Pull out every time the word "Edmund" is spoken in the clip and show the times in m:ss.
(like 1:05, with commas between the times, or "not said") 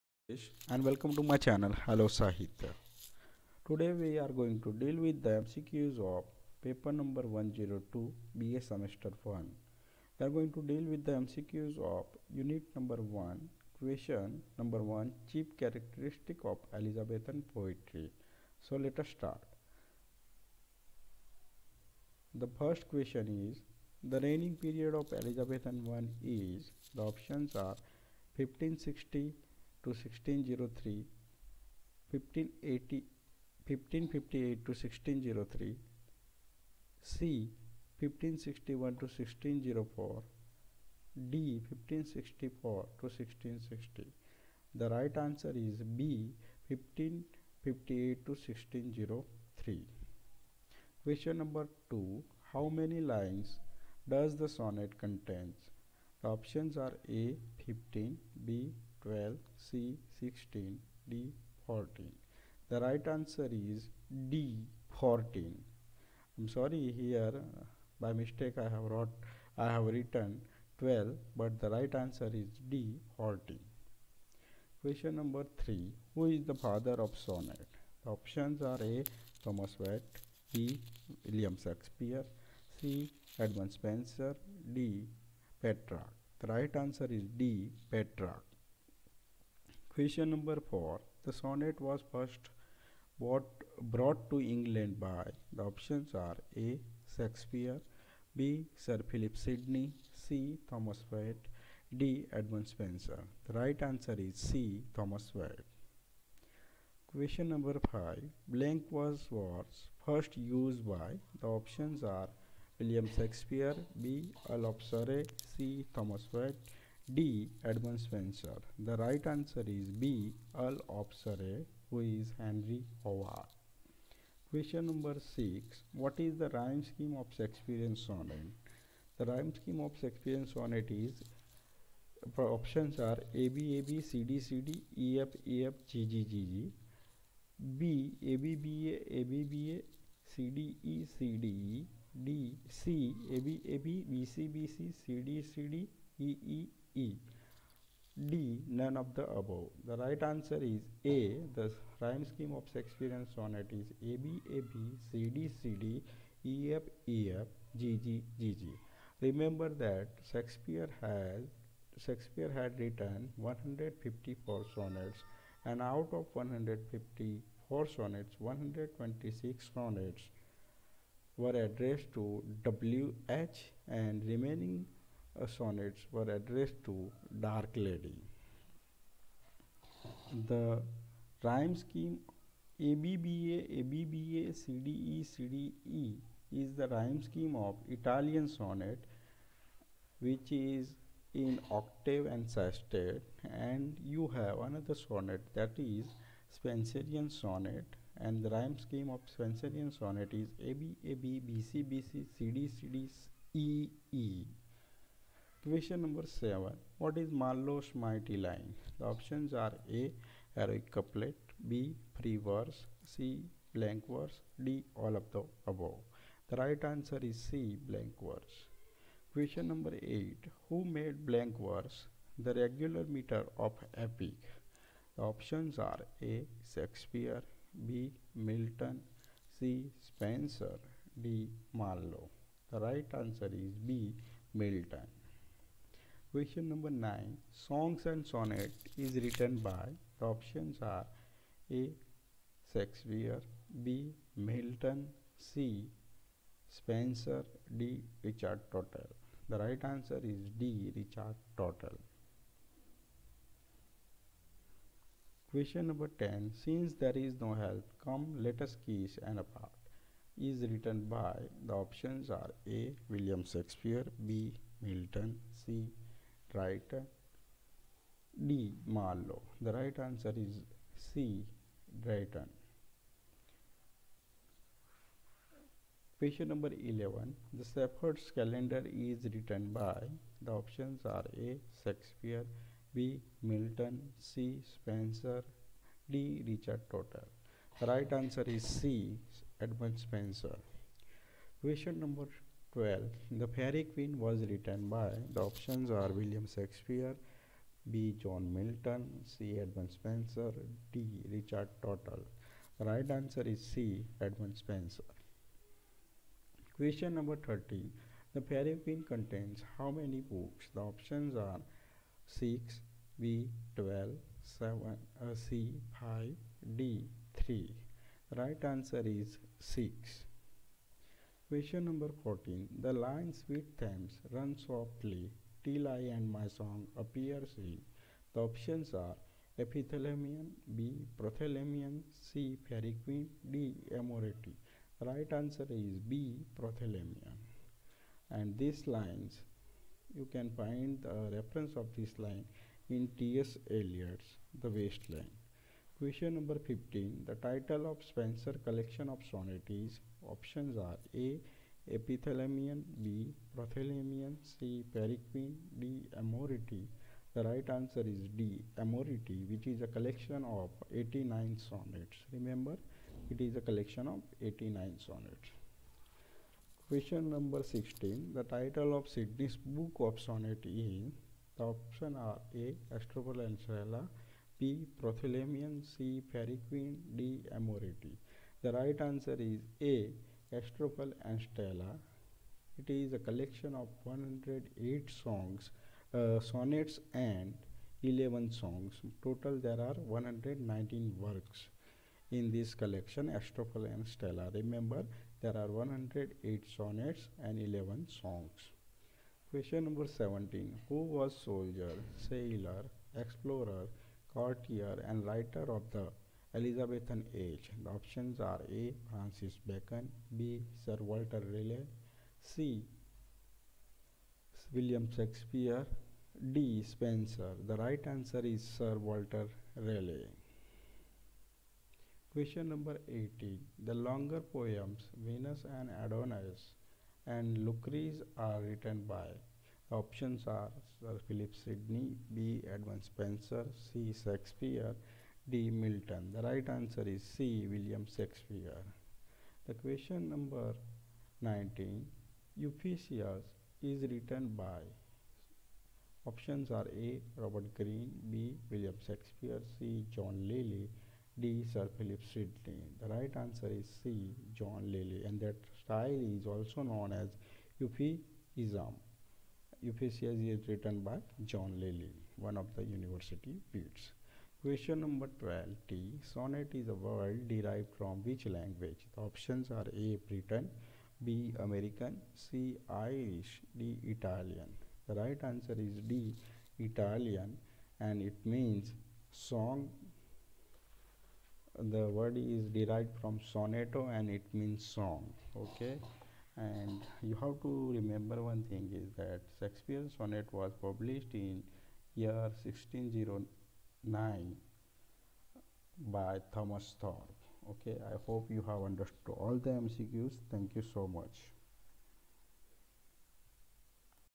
1:23, 1:42, 1:57, 4:49, 4:59, 5:04, 7:12.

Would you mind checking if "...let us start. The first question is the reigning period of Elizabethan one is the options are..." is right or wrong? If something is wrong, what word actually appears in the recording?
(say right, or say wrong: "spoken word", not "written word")
right.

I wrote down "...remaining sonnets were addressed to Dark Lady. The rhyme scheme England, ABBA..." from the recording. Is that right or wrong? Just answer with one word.
wrong.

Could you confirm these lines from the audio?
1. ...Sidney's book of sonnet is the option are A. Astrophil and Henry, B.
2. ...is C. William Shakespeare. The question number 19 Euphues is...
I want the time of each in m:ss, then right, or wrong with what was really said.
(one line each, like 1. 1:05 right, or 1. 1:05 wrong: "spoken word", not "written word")
1. 6:09 wrong: "Stella", not "Henry"
2. 7:17 right.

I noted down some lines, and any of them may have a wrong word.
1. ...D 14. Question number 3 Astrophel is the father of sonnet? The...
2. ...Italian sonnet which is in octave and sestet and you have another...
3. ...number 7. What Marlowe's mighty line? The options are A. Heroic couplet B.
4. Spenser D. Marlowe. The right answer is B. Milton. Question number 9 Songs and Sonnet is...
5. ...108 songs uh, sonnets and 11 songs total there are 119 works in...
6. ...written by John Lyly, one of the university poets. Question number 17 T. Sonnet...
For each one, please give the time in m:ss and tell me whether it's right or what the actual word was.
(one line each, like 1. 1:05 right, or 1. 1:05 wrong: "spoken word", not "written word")
1. 1:12 wrong: "Who", not "Astrophel"
2. 3:07 right
3. 3:26 right
4. 3:50 right
5. 6:24 right
6. 7:40 wrong: "12", not "17".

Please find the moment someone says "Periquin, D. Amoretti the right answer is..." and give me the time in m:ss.
5:54.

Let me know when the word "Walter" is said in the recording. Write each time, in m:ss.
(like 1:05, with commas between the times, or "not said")
6:50, 6:58.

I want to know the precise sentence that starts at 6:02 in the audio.
Remember, it is a collection of 89 sonnets.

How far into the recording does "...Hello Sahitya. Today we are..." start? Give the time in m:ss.
0:01.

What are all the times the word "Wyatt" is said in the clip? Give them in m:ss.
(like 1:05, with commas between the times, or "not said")
1:19, 1:41, 1:45, 1:56.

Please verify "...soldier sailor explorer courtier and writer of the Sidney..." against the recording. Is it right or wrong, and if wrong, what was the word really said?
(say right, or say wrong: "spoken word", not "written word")
wrong: "Elizabethan", not "Sidney".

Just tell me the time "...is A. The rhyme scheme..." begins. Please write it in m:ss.
2:30.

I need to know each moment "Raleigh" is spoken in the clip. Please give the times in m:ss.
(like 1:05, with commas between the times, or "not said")
6:51, 6:59.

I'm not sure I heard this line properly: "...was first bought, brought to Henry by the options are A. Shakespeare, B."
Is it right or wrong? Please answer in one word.
wrong.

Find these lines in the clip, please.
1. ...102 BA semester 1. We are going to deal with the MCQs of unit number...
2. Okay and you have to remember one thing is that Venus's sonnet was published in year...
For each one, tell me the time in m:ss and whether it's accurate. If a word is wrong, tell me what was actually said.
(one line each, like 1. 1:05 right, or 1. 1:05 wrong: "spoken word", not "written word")
1. 0:07 right
2. 8:05 wrong: "Shakespeare", not "Venus".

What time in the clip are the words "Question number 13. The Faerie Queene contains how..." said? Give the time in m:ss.
5:06.